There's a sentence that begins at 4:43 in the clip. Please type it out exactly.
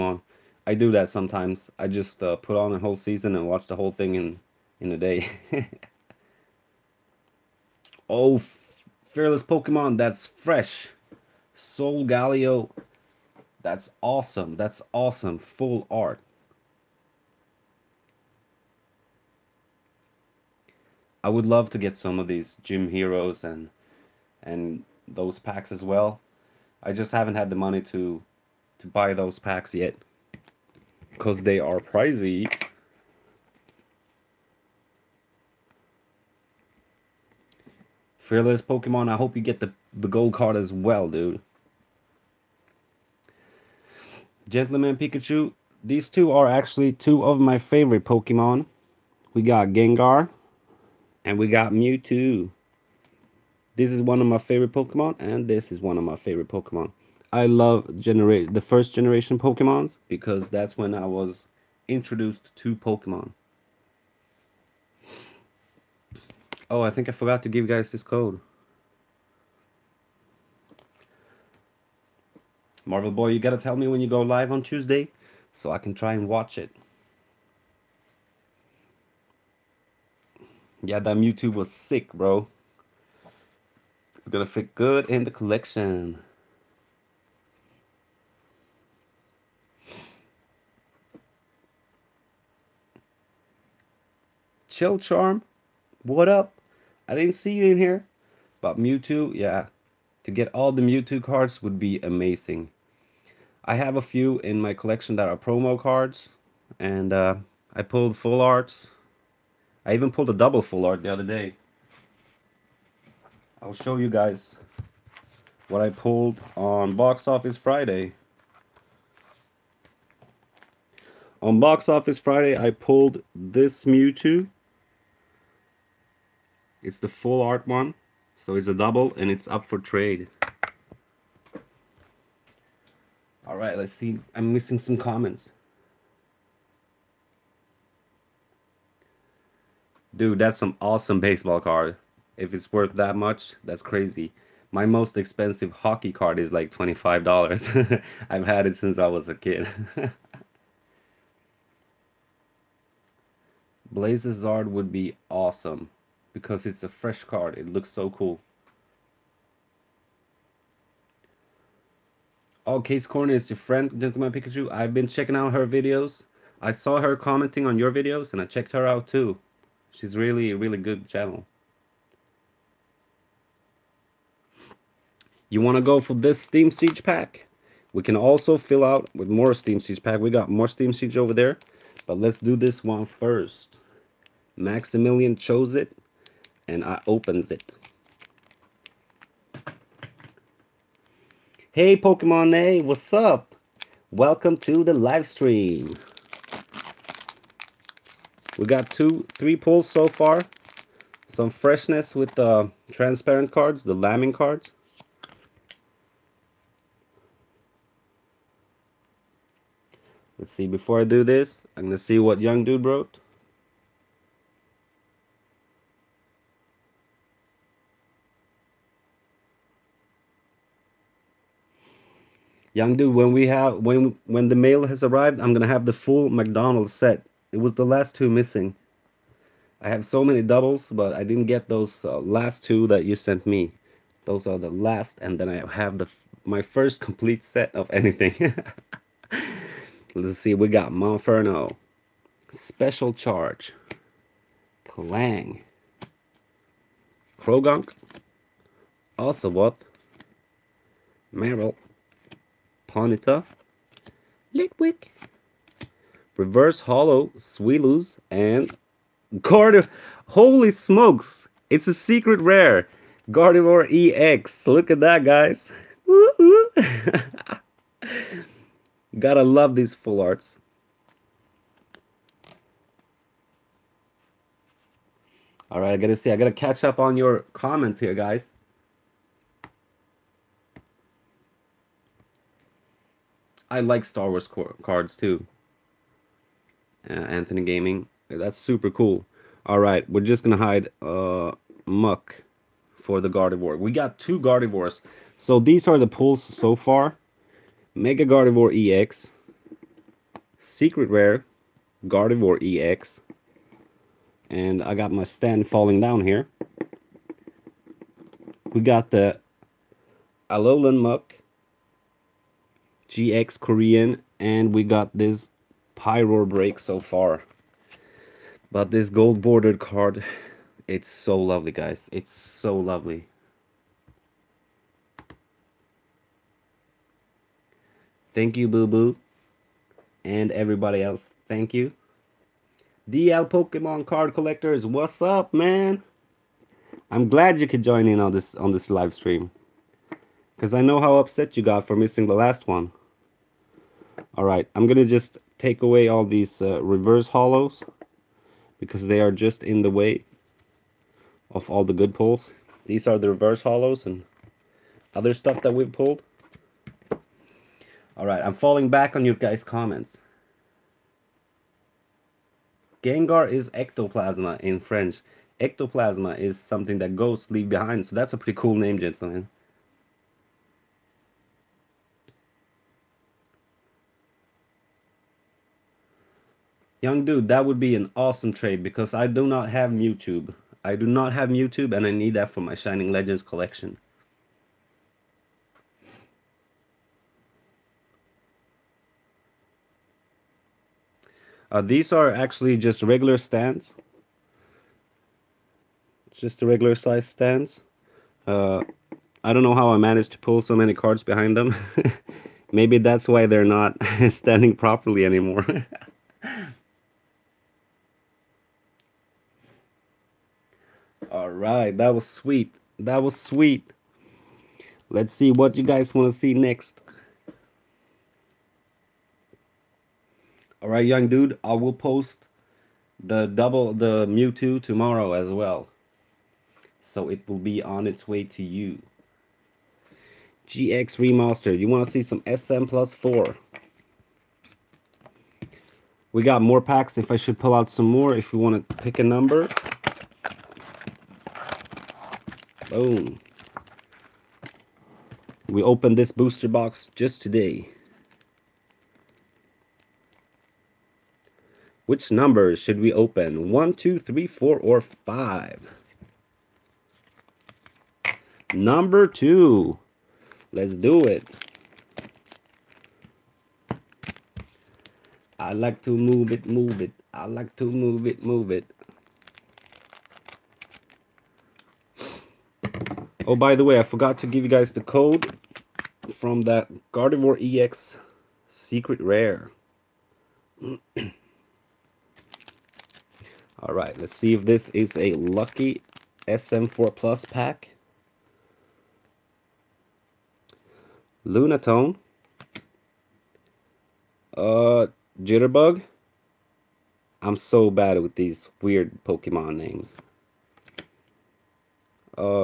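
I like Star Wars cards too uh, Anthony Gaming.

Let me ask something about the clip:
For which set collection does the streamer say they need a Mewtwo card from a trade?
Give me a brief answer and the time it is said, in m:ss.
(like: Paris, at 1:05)
Shining Legends, at 6:22.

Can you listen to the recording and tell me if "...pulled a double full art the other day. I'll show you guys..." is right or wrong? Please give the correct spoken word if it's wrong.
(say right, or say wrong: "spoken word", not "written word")
right.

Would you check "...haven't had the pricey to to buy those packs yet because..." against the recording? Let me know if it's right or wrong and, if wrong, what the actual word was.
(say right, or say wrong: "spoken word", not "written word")
wrong: "money", not "pricey".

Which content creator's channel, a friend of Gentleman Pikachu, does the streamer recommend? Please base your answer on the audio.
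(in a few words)
Kate's Corner.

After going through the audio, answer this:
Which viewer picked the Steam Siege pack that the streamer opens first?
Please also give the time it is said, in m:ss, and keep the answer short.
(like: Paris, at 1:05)
Maximilian, at 3:04.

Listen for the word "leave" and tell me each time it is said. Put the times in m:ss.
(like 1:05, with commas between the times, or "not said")
6:07.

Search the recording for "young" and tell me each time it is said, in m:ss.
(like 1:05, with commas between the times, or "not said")
3:32, 3:42, 6:17, 7:01.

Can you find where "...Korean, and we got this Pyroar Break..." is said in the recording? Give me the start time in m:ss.
5:13.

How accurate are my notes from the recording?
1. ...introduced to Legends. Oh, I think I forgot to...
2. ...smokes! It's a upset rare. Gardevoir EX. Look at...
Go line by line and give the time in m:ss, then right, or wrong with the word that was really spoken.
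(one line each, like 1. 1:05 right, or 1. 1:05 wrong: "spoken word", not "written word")
1. 1:01 wrong: "Pokemon", not "Legends"
2. 4:20 wrong: "secret", not "upset".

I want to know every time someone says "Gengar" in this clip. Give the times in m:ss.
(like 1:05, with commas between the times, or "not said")
0:49, 6:03.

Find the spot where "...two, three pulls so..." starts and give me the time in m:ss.
3:18.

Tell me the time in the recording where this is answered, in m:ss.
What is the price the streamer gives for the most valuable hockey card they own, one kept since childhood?
2:26.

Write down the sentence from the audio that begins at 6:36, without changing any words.
It's just the regular size stands.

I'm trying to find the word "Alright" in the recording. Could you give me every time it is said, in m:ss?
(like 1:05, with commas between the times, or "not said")
2:13, 5:44, 5:58, 8:03.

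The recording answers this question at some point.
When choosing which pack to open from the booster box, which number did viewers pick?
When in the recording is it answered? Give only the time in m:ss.
7:38.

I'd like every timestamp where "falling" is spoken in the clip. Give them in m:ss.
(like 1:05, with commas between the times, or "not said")
5:05, 5:58.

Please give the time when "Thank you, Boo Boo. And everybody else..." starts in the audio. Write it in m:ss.
5:28.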